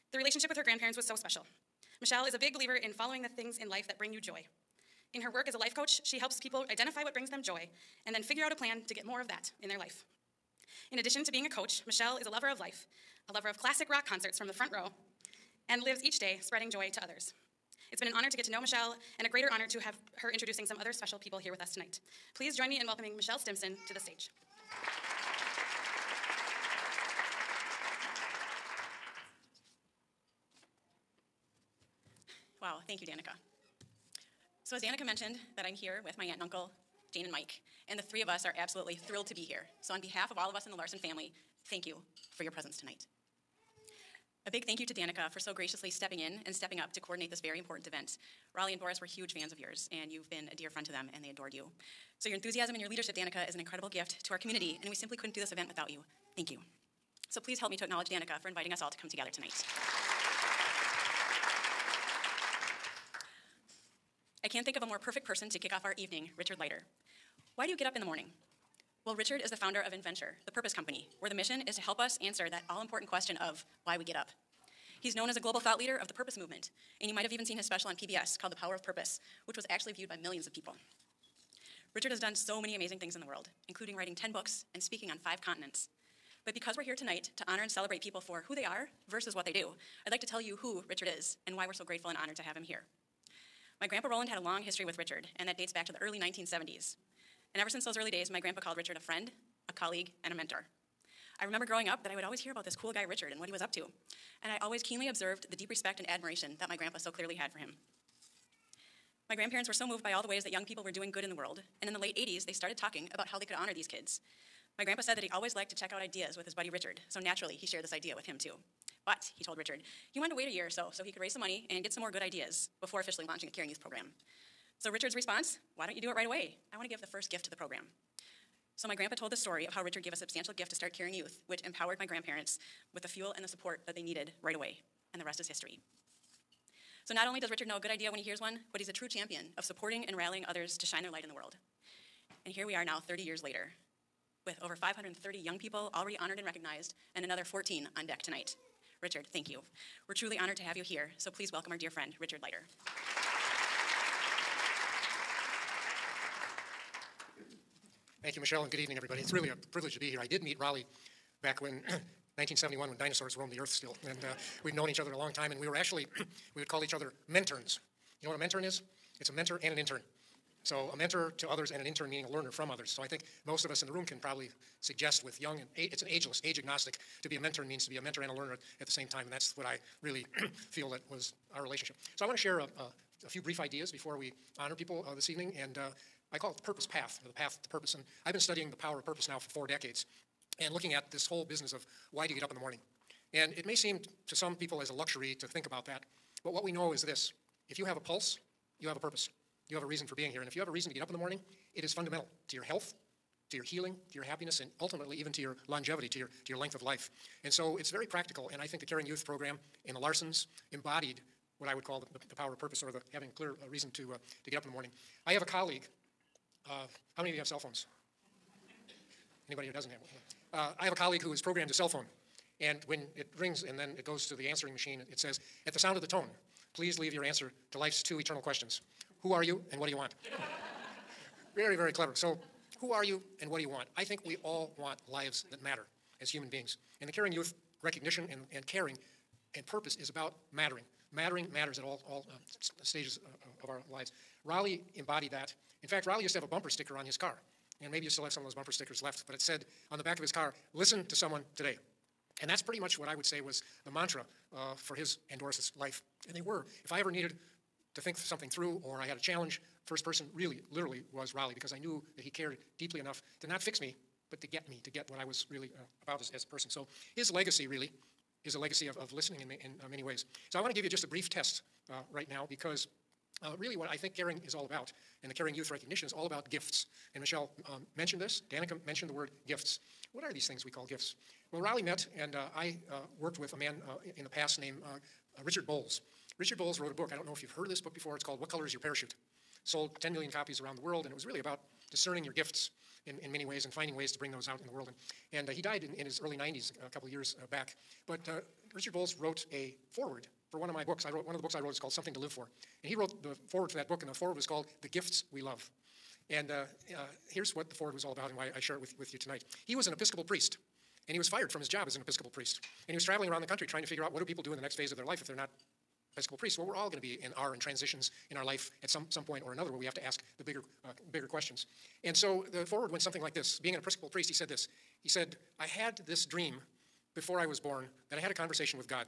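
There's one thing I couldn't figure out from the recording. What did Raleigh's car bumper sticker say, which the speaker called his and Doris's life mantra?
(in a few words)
Listen to someone today.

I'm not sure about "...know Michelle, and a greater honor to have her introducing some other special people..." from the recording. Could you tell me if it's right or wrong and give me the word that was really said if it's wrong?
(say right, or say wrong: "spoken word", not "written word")
right.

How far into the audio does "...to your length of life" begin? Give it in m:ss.
3:26.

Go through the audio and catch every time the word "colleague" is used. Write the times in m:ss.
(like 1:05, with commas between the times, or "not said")
1:39, 3:35, 3:40.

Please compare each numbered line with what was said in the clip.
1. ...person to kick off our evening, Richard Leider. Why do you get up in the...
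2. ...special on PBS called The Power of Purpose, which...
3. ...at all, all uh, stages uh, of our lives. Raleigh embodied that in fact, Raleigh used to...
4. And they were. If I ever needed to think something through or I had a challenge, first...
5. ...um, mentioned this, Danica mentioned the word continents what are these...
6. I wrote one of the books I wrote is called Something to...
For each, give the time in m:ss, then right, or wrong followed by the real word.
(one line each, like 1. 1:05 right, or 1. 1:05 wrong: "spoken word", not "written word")
1. 1:05 right
2. 1:17 right
3. 4:01 right
4. 4:16 right
5. 4:37 wrong: "gifts", not "continents"
6. 5:01 right.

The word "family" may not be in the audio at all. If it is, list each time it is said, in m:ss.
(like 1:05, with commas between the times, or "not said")
0:40.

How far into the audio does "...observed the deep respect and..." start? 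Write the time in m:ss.
1:45.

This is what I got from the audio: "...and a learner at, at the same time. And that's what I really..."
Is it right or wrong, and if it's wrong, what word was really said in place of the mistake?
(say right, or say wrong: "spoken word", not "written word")
right.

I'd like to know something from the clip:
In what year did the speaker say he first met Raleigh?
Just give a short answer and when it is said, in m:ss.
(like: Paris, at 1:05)
1971, at 2:42.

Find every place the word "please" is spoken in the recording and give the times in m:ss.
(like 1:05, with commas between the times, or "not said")
0:22, 0:57, 2:31, 3:46.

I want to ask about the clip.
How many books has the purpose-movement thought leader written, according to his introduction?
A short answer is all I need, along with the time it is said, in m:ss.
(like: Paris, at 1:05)
10, at 1:24.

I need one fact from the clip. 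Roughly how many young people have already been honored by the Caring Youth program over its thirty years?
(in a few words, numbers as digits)
530.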